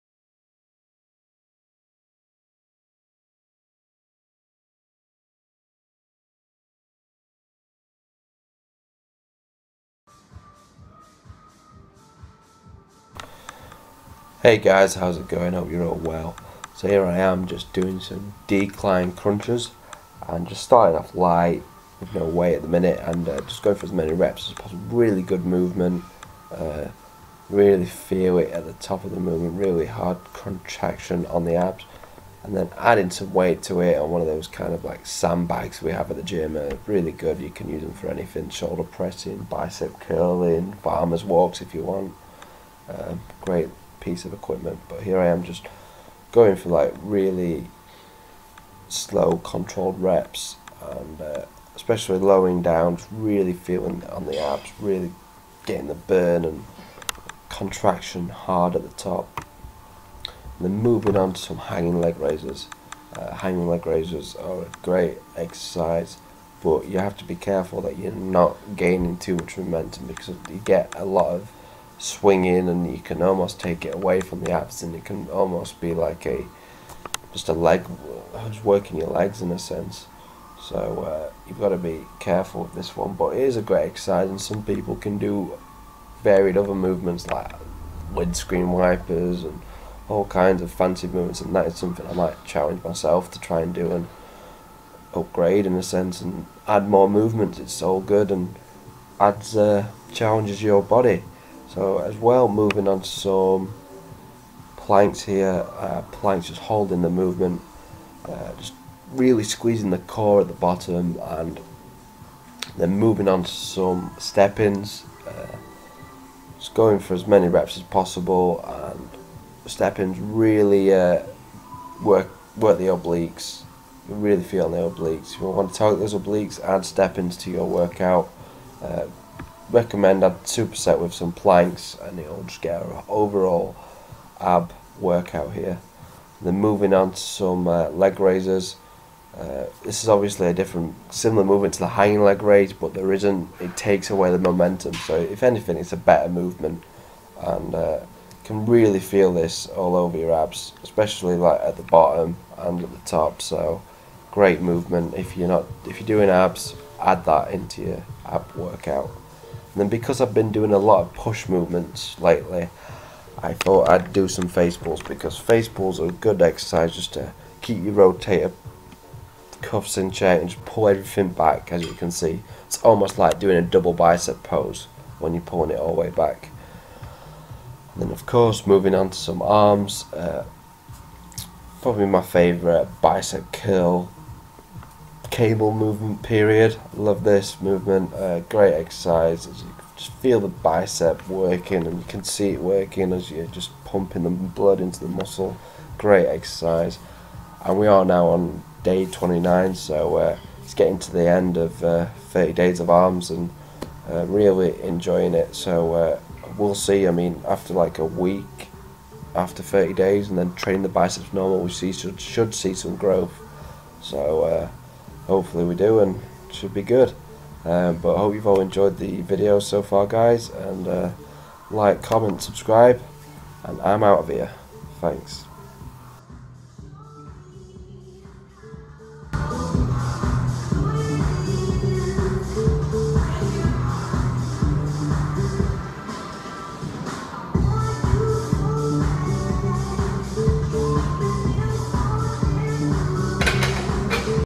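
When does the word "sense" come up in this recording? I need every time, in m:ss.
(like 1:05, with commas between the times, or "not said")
1:19, 1:35.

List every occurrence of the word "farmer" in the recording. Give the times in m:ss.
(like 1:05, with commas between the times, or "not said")
0:40.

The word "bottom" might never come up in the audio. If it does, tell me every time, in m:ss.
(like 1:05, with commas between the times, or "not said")
1:50, 2:31.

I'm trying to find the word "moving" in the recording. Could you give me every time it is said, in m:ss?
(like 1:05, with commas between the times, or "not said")
1:00, 1:42, 1:52, 2:16, 2:58.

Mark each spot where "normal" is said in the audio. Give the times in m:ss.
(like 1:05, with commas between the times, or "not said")
3:31.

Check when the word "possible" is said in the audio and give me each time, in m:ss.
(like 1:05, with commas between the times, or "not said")
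0:24, 1:57.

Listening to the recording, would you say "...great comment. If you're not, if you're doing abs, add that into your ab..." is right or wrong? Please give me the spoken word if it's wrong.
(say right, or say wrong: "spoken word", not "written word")
wrong: "movement", not "comment".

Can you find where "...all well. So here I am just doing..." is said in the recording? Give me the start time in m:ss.
0:15.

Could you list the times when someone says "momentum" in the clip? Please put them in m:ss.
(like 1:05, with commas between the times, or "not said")
1:09, 2:24.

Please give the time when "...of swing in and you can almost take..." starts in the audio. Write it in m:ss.
1:11.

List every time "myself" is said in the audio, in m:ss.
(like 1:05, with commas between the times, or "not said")
1:32.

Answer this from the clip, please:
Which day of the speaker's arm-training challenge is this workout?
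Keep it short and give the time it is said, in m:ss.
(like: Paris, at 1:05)
Day 29, at 3:18.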